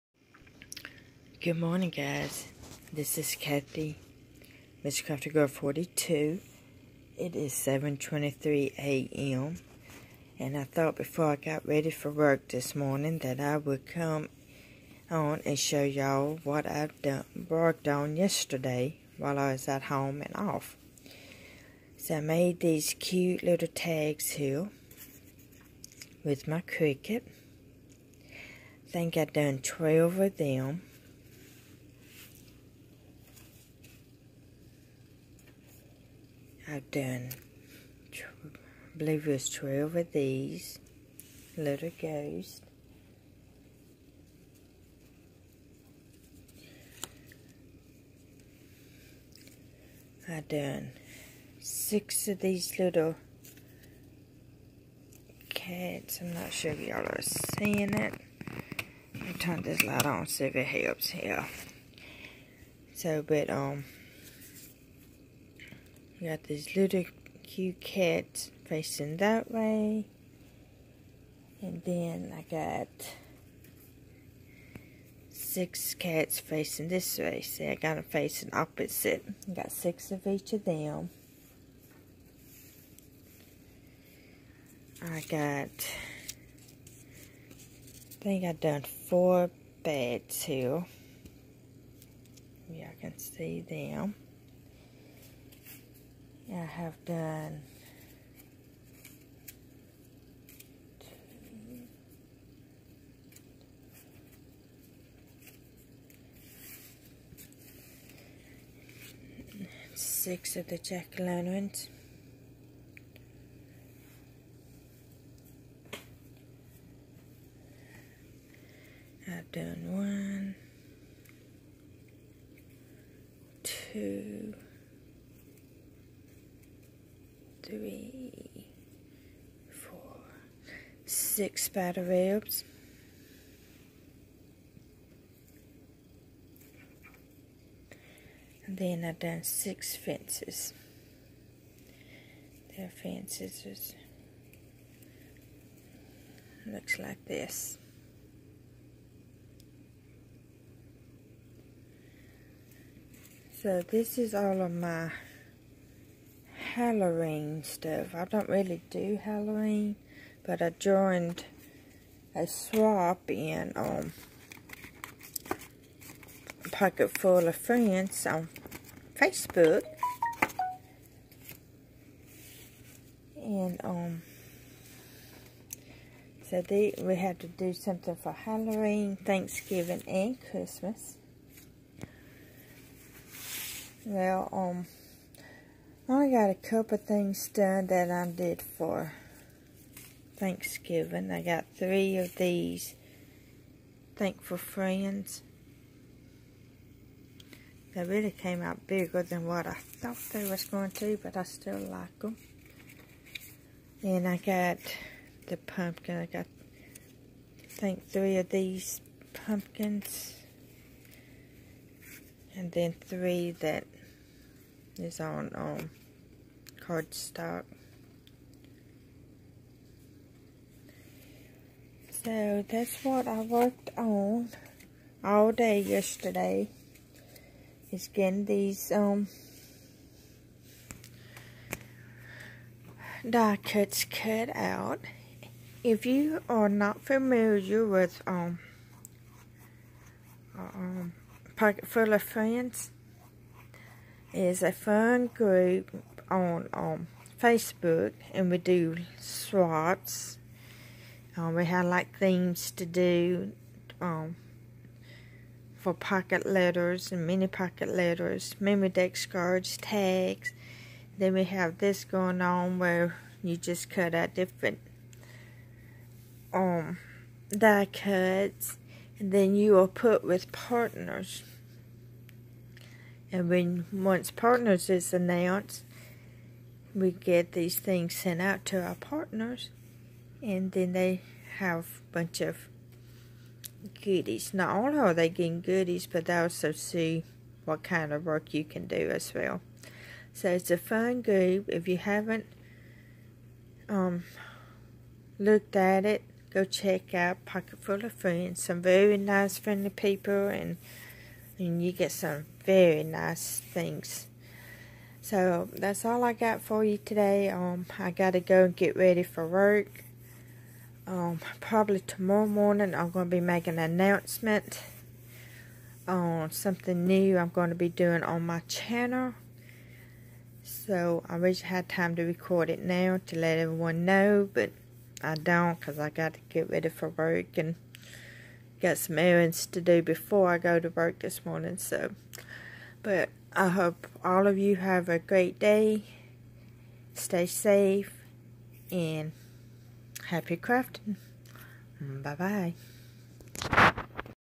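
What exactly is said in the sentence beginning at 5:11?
Um, probably tomorrow morning I'm gonna be making an announcement on something new I'm gonna be doing on my channel.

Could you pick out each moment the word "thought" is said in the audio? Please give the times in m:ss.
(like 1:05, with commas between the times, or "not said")
0:10, 3:19.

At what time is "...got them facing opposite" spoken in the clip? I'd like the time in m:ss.
1:17.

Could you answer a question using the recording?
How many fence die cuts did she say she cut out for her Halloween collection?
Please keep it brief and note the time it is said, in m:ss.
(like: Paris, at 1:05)
6, at 2:19.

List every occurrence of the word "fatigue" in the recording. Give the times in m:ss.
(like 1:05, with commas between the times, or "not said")
not said.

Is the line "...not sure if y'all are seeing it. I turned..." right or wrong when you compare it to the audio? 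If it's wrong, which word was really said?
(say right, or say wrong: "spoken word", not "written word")
right.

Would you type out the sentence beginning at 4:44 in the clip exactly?
Not only are they getting goodies, but they also see what kind of work you can do as well.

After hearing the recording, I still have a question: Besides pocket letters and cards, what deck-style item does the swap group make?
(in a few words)
memory decks.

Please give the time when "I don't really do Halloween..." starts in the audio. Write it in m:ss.
2:38.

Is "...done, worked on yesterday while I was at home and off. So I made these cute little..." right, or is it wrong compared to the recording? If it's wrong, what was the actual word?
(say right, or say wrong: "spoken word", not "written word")
right.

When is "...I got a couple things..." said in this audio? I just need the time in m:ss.
3:06.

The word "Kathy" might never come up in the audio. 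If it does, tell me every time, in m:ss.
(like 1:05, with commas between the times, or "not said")
0:03.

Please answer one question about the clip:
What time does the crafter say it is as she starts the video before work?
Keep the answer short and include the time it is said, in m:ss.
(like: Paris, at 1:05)
7:23 a.m., at 0:07.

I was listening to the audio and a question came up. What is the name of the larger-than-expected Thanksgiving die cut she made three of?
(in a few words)
Thankful Friends.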